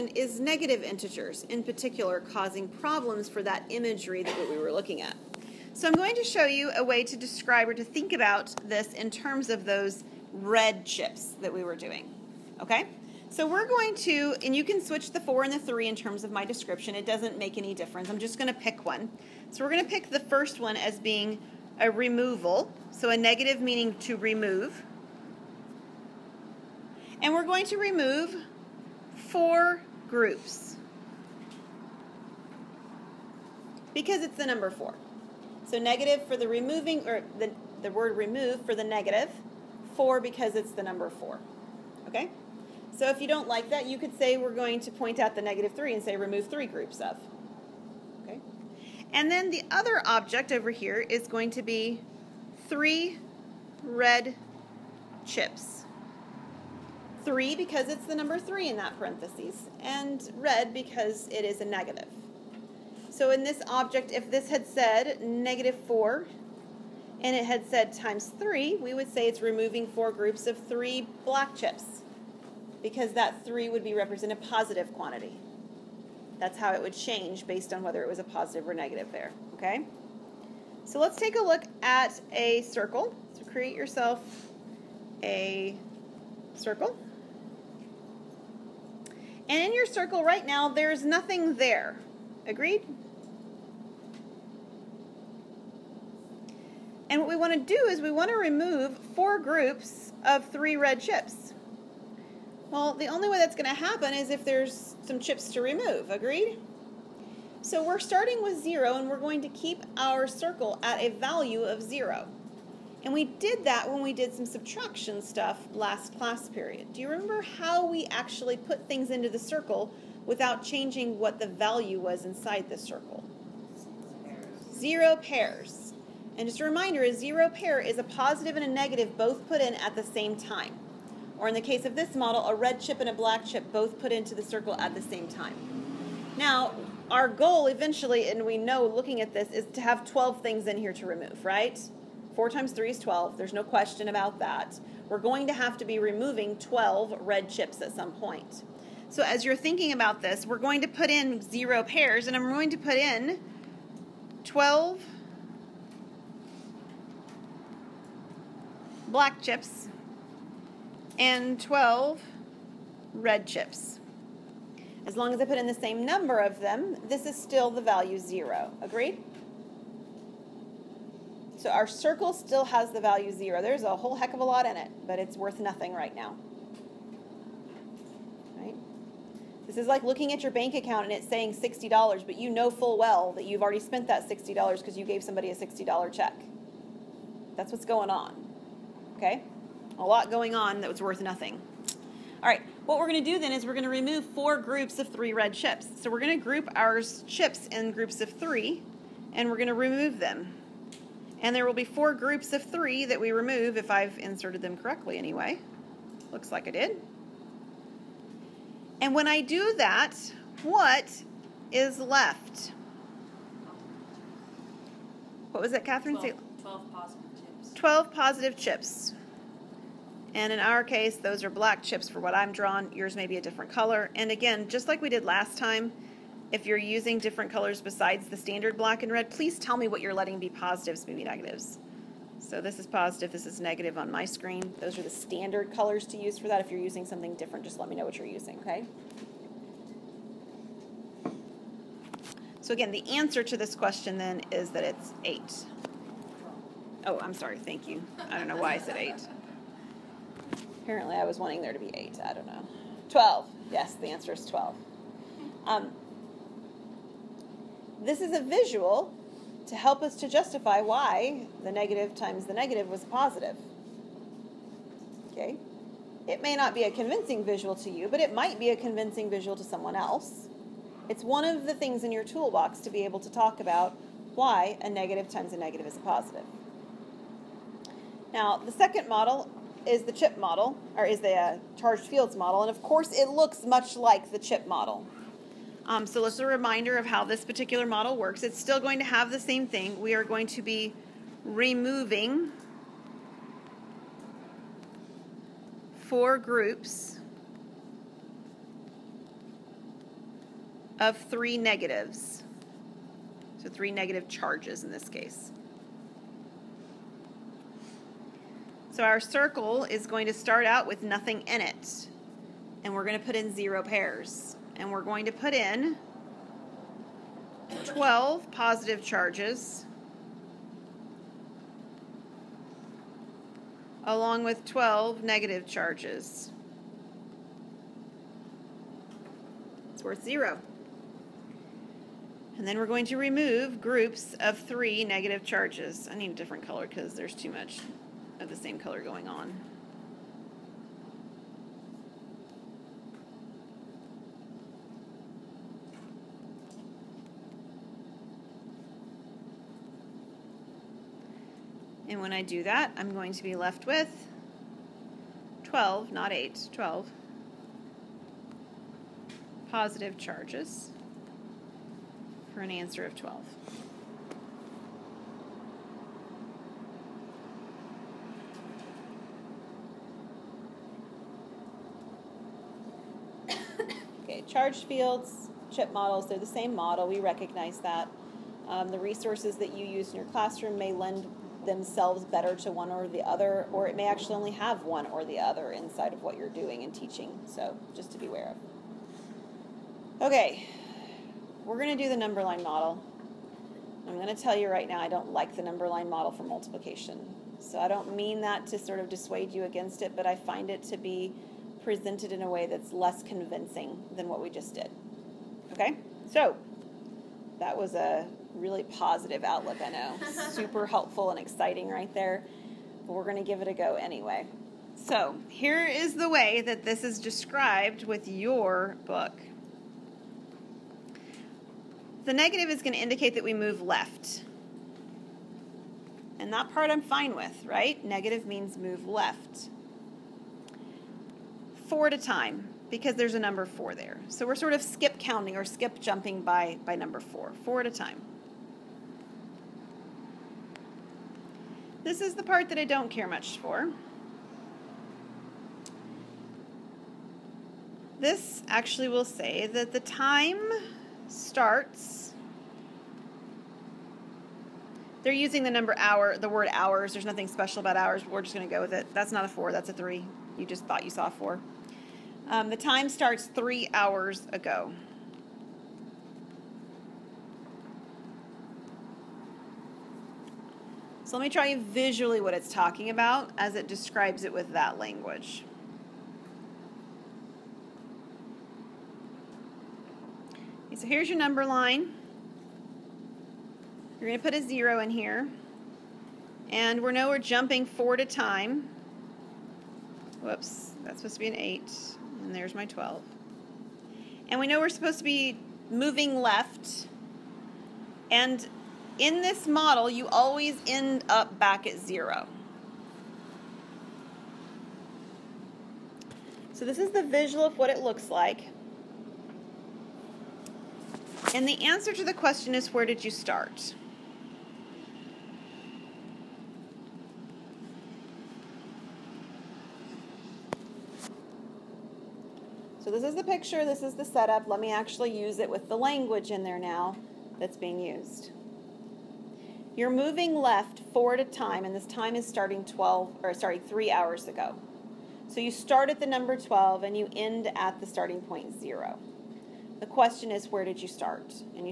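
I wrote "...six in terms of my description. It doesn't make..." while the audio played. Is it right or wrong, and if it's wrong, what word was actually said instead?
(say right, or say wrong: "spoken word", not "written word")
wrong: "three", not "six".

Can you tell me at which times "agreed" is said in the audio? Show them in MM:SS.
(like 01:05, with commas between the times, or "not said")
01:32, 01:46, 02:48.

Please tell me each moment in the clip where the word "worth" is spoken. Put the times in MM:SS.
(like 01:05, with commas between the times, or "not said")
02:55, 03:11, 05:30.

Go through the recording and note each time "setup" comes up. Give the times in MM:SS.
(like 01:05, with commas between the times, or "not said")
08:44.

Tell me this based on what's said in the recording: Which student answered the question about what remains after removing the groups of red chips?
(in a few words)
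Catherine.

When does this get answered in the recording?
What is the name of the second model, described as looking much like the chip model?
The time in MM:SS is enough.
04:41.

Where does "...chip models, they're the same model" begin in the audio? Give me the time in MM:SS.
06:15.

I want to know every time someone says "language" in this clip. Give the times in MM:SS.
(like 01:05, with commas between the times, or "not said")
07:54, 08:45.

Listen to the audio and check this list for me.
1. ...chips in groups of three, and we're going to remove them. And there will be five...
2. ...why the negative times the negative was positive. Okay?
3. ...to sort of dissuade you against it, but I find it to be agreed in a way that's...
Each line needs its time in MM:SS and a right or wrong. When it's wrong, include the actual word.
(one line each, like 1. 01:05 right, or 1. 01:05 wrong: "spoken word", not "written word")
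1. 03:17 wrong: "four", not "five"
2. 04:20 right
3. 06:38 wrong: "presented", not "agreed".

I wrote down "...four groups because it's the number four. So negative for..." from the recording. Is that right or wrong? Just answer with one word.
right.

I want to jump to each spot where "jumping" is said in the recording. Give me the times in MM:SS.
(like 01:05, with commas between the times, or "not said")
07:15, 08:07.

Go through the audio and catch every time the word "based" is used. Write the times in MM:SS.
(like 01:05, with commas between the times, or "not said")
01:17.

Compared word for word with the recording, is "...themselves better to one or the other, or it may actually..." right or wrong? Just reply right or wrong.
right.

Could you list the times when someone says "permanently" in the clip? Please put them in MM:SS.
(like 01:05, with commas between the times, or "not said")
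not said.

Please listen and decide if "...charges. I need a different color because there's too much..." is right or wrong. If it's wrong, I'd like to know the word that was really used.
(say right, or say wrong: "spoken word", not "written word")
right.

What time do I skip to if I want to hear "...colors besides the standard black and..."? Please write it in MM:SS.
03:47.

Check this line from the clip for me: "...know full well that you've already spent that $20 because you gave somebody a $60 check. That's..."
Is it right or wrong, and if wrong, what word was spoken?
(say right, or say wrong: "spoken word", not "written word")
wrong: "60", not "20".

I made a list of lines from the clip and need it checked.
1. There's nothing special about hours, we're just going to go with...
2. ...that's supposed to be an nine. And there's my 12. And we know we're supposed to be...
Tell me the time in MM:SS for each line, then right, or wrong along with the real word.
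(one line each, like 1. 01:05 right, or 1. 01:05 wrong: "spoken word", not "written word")
1. 07:37 right
2. 08:11 wrong: "eight", not "nine".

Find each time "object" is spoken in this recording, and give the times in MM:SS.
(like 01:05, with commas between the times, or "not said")
00:50, 01:03.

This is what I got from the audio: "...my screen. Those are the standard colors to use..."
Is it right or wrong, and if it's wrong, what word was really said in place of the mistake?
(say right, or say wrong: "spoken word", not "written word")
right.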